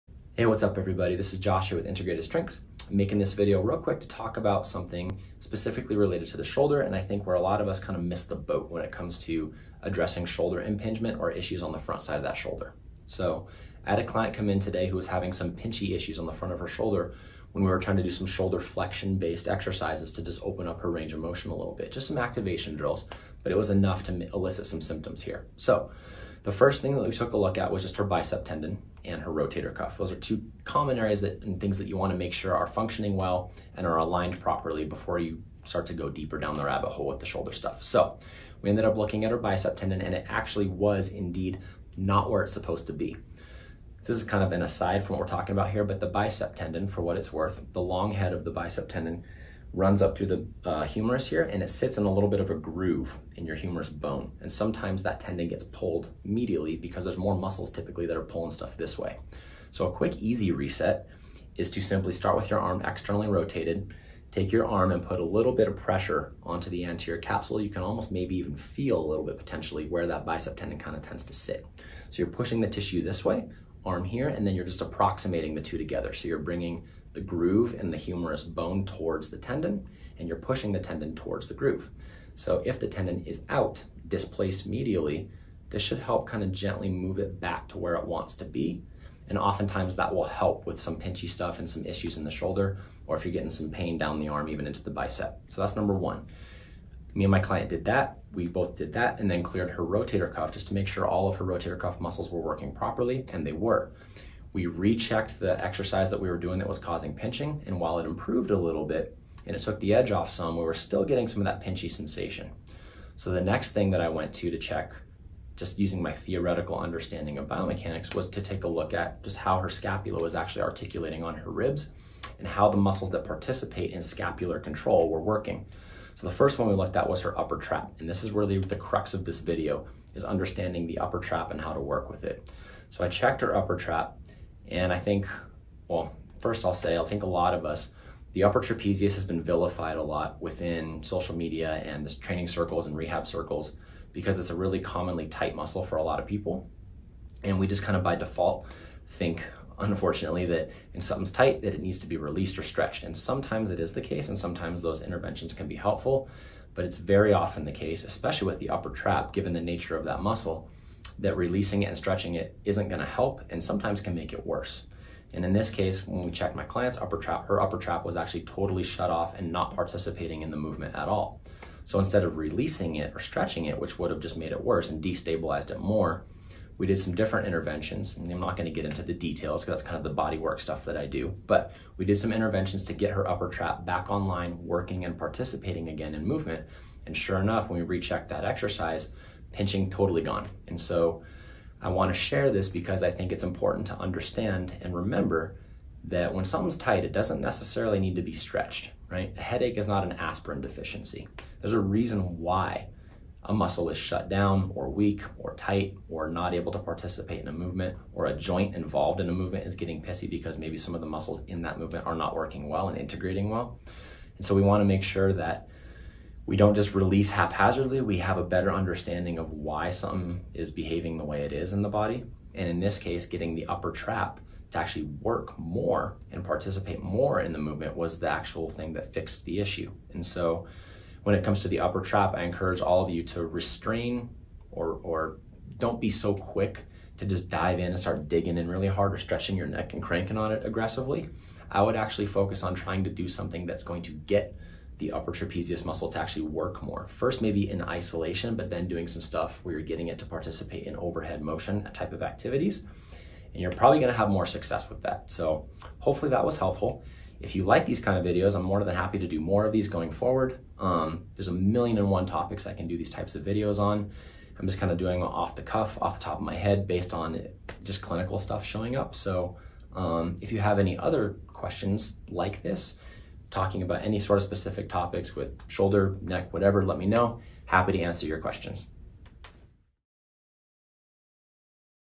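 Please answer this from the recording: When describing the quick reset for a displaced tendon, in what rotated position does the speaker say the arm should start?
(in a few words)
Externally rotated.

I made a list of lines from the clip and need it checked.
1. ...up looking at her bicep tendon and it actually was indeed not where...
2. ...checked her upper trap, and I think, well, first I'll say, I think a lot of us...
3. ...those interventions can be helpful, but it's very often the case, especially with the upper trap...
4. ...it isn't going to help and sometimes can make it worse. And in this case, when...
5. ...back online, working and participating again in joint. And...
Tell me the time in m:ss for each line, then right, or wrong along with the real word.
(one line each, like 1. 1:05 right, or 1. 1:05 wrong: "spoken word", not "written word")
1. 0:38 right
2. 2:13 right
3. 2:34 right
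4. 2:42 right
5. 3:03 wrong: "movement", not "joint".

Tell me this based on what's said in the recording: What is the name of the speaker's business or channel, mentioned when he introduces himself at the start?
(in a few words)
Integrated Strength.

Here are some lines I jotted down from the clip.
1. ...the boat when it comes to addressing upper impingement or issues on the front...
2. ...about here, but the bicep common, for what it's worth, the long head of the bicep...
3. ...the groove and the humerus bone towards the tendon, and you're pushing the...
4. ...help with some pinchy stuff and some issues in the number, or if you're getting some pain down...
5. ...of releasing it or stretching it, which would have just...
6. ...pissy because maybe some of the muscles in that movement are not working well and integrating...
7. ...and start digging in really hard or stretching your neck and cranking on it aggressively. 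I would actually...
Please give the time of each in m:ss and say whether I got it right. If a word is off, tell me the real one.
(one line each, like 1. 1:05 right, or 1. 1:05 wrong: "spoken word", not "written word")
1. 0:08 wrong: "shoulder", not "upper"
2. 0:45 wrong: "tendon", not "common"
3. 1:17 right
4. 1:30 wrong: "shoulder", not "number"
5. 2:52 right
6. 3:30 right
7. 3:57 right.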